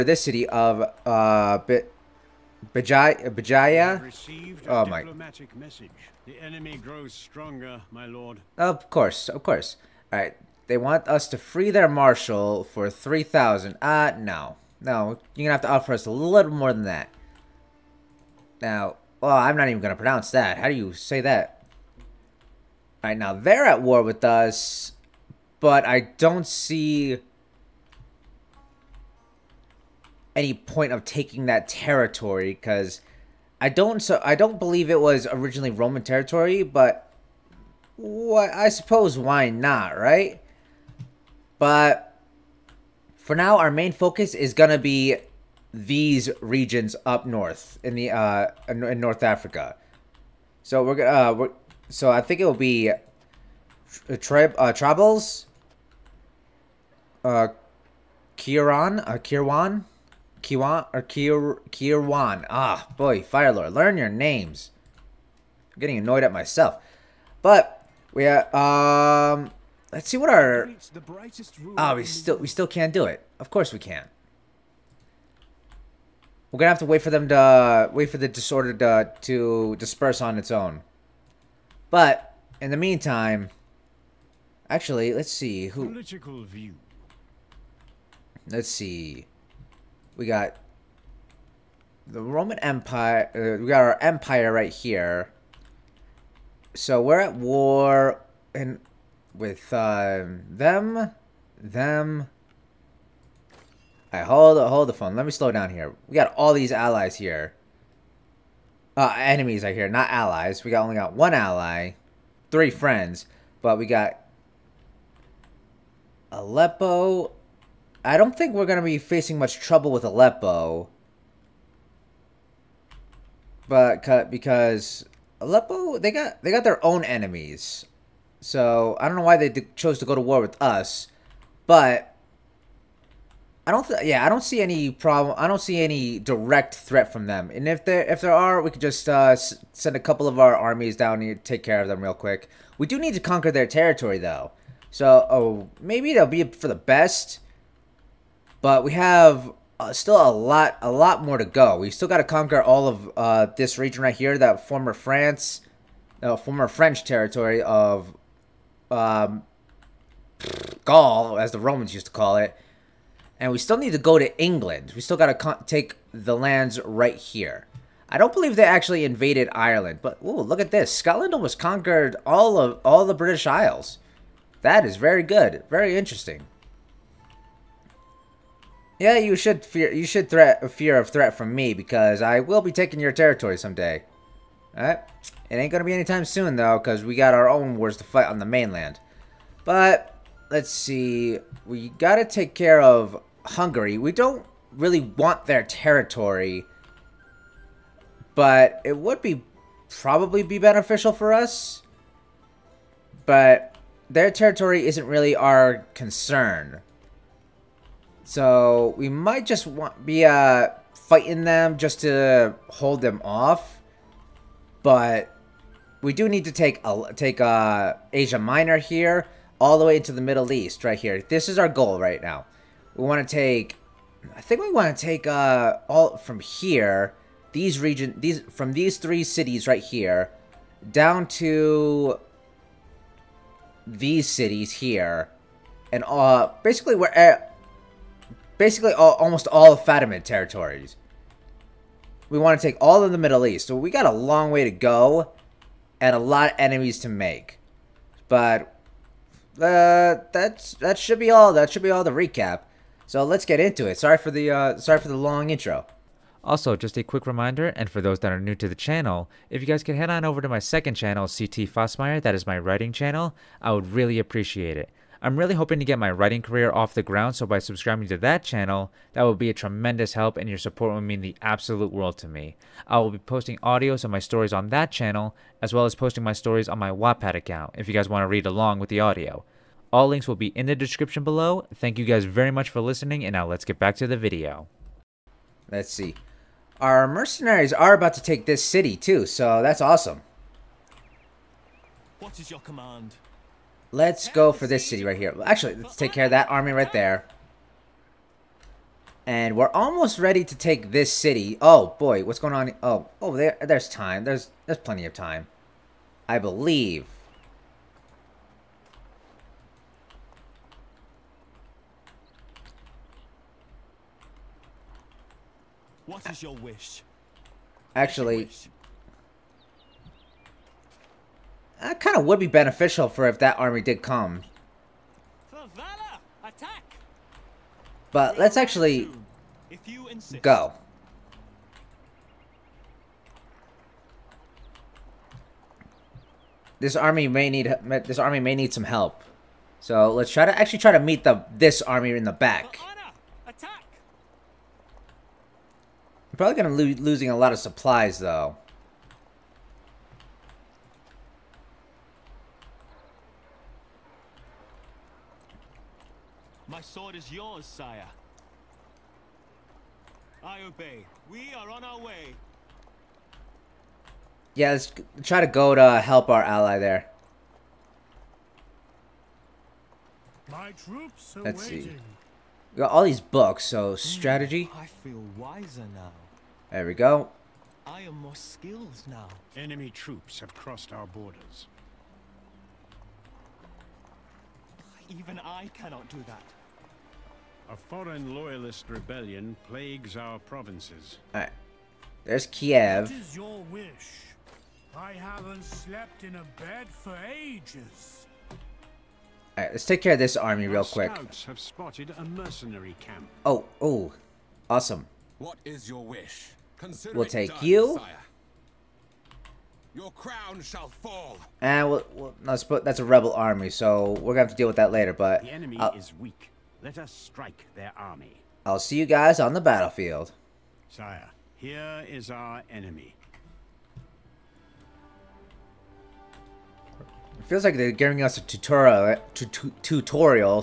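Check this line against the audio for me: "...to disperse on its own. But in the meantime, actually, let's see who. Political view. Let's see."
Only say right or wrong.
right.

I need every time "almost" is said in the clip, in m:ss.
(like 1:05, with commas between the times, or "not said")
2:51, 3:59, 4:59.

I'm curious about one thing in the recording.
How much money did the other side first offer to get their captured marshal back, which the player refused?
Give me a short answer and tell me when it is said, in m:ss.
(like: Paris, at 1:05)
3000, at 0:12.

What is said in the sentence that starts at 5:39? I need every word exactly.
So let's try to actually try to meet the this army in the back.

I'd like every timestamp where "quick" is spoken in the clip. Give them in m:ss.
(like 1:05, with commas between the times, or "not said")
2:22, 4:17, 6:40.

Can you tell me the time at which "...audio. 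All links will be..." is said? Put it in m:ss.
4:38.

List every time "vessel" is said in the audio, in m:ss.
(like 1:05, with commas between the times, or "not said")
not said.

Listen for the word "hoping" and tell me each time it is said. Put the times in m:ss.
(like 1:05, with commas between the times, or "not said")
4:25.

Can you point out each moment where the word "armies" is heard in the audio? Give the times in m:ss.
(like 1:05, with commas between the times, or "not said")
2:20.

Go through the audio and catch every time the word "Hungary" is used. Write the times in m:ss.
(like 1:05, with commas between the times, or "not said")
3:13.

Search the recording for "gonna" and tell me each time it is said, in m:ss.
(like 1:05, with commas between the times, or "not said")
0:15, 0:44, 0:50, 1:16, 3:05, 6:54.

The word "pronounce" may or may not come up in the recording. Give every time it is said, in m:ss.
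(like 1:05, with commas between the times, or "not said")
0:19.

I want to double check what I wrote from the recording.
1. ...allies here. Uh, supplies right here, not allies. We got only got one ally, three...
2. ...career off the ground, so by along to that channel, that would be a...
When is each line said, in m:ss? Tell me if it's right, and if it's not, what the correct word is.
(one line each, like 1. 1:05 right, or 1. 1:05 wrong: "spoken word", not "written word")
1. 1:46 wrong: "enemies", not "supplies"
2. 4:26 wrong: "subscribing", not "along".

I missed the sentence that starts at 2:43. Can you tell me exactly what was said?
And we still need to go to England.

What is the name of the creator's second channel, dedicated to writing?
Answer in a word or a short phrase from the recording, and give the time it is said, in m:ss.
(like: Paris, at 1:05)
CT Fossmeyer, at 4:21.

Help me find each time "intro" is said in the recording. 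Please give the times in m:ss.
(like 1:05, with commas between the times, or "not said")
4:15.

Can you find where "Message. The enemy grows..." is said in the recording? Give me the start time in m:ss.
0:05.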